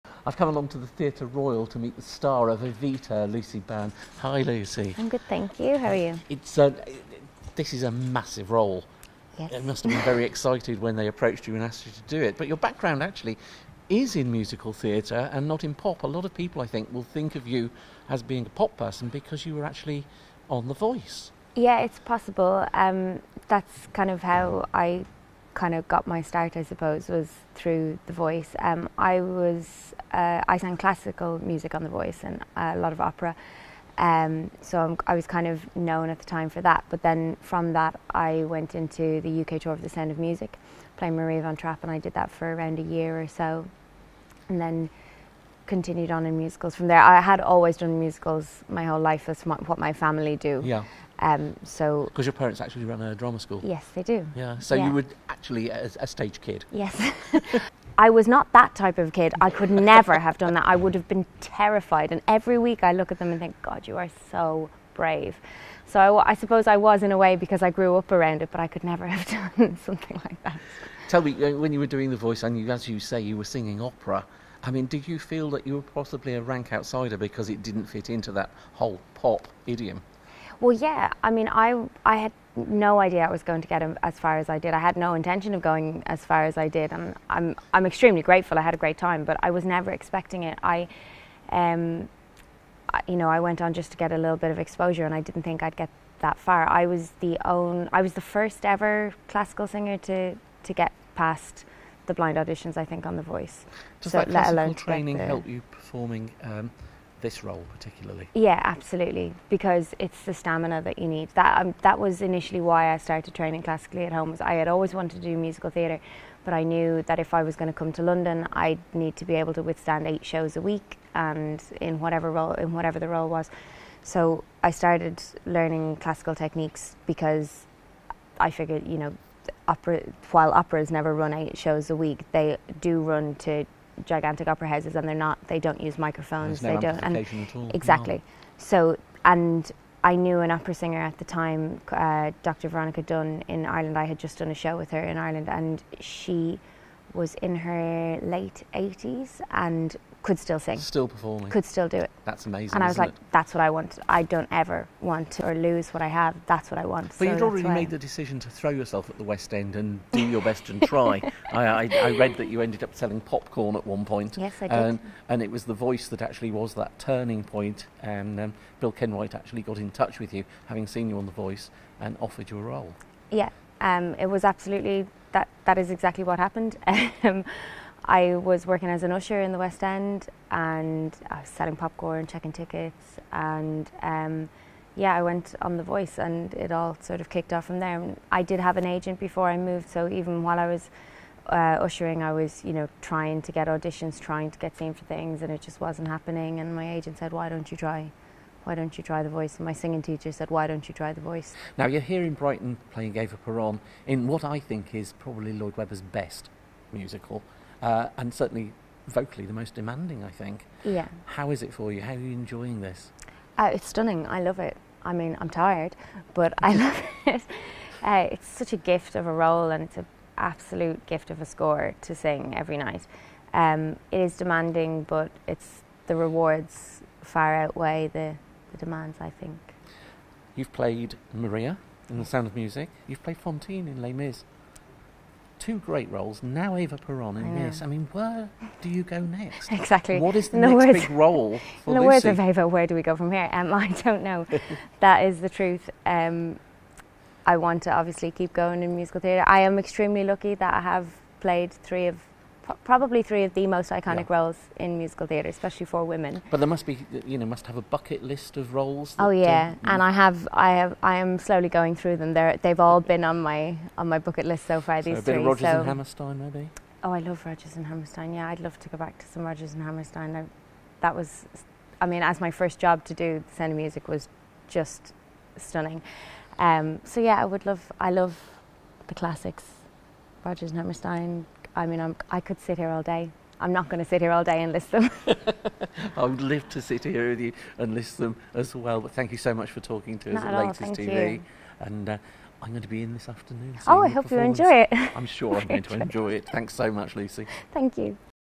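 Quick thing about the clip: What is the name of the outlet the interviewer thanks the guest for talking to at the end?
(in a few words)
Latest TV.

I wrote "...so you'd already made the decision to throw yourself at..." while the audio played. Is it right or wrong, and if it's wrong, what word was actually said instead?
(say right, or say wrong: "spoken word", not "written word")
right.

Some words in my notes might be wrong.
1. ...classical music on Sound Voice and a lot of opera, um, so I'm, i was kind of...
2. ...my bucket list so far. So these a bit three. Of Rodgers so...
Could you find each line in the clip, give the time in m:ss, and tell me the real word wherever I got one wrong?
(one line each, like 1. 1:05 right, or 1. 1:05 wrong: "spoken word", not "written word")
1. 0:30 wrong: "The", not "Sound"
2. 4:24 right.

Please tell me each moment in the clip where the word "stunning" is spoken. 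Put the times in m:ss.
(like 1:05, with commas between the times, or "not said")
3:33, 4:35.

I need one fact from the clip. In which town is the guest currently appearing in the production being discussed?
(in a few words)
Brighton.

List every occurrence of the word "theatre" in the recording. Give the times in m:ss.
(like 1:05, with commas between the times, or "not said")
0:00, 0:14, 1:55, 4:09, 4:15.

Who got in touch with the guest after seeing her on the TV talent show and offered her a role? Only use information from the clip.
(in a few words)
Bill Kenwright.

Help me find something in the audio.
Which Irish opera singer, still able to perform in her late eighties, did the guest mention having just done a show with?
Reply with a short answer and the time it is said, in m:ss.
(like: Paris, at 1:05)
Veronica Dunne, at 2:22.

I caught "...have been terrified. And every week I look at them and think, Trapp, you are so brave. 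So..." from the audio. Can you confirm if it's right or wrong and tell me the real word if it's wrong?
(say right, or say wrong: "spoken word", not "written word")
wrong: "God", not "Trapp".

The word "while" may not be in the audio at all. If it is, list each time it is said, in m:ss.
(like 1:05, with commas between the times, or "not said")
2:10, 3:10.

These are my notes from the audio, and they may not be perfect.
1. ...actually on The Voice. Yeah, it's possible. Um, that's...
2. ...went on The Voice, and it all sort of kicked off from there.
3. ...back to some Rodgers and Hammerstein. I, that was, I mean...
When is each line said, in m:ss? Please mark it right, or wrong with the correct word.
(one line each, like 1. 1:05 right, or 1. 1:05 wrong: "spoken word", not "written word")
1. 0:19 right
2. 3:05 right
3. 4:28 right.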